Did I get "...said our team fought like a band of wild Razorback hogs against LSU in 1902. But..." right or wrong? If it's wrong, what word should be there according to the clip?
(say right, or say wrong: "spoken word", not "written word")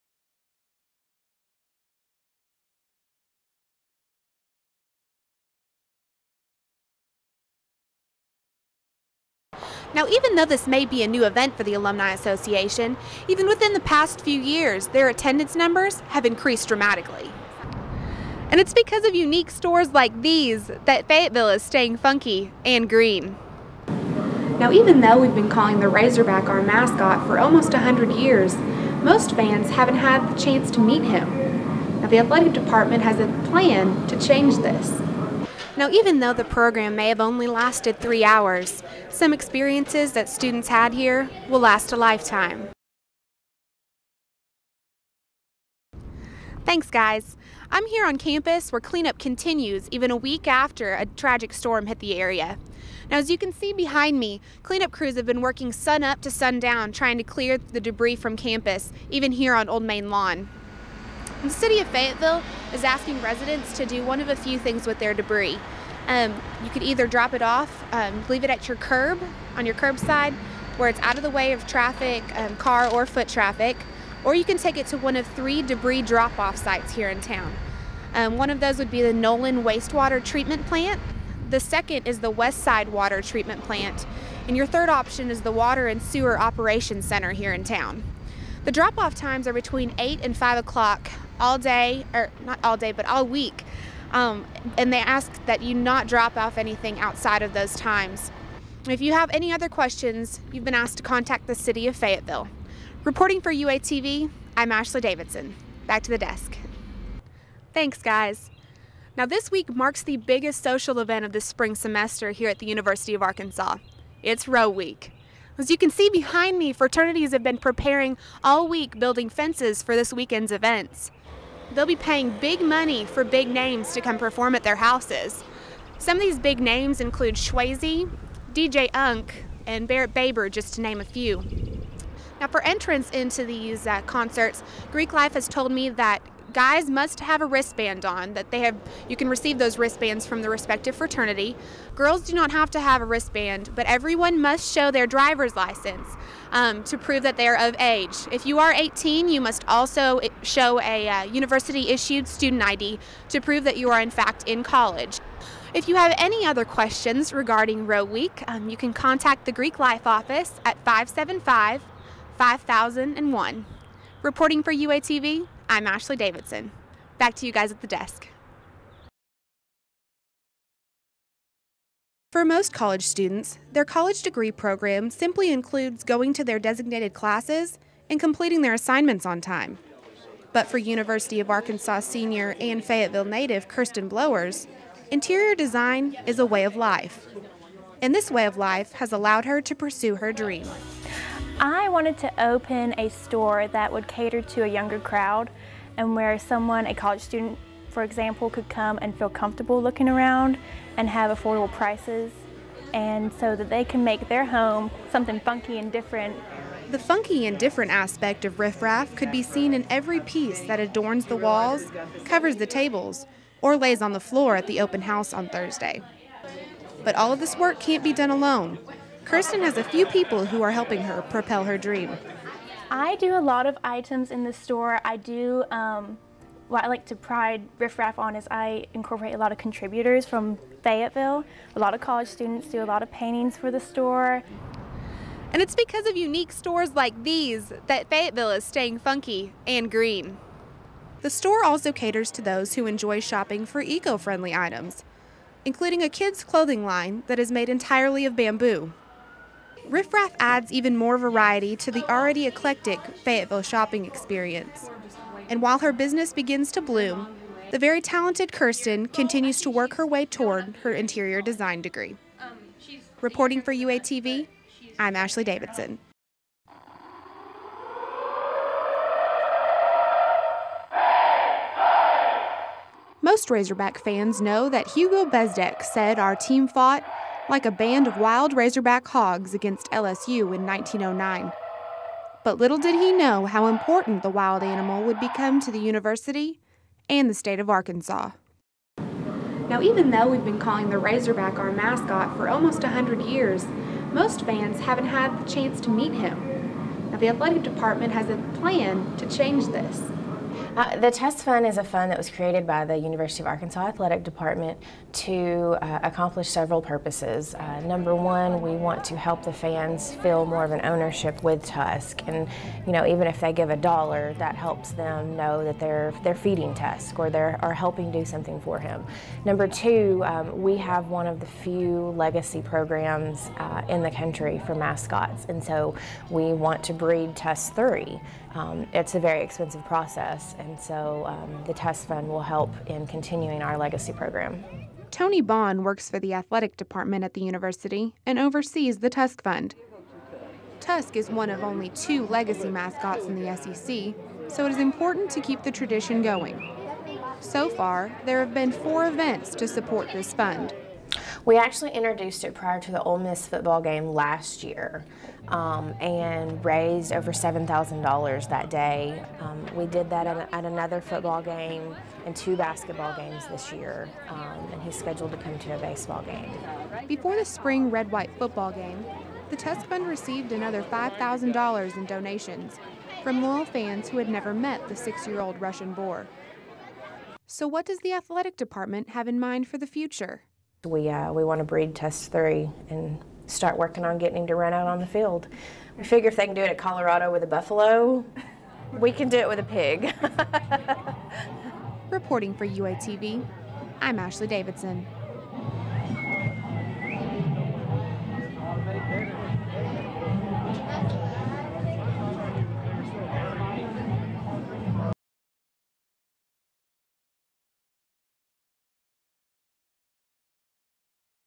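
wrong: "1909", not "1902".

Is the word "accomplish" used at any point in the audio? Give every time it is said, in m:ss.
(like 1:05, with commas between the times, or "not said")
5:06.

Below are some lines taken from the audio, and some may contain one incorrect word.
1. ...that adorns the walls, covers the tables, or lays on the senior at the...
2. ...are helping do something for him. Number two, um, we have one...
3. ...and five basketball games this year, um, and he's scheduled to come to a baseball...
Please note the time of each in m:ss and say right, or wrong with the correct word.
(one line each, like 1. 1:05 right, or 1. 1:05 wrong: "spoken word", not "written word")
1. 3:30 wrong: "floor", not "senior"
2. 5:17 right
3. 6:02 wrong: "two", not "five".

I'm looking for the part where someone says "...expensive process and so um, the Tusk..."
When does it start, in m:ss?
5:29.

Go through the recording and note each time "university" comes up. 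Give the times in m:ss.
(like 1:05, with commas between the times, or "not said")
1:52, 2:31, 3:00, 4:45, 5:02, 5:37.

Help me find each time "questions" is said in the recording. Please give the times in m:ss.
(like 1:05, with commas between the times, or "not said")
1:39, 2:36.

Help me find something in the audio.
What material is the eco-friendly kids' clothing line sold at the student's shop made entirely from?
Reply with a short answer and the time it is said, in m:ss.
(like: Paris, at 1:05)
Bamboo, at 4:08.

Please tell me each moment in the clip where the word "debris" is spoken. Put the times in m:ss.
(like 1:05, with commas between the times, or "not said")
0:57, 1:05, 1:15.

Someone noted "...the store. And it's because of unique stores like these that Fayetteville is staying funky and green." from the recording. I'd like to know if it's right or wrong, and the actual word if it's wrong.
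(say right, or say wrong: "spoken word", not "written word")
right.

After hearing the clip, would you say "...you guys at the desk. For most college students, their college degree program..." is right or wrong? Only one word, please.
right.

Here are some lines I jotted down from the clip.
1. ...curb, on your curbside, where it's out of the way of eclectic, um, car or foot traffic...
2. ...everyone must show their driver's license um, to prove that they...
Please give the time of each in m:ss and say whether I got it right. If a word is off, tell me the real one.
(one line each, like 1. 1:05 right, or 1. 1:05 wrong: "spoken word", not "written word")
1. 1:08 wrong: "traffic", not "eclectic"
2. 2:23 right.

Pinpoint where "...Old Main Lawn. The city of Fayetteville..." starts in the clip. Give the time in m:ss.
0:59.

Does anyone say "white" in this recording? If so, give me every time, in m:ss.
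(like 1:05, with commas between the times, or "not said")
6:08.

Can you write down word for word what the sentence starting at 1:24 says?
And your third option is the Water and Sewer Operations Center here in town.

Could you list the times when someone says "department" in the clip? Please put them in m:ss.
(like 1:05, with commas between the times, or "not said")
0:32, 4:57, 5:04, 5:36, 6:18.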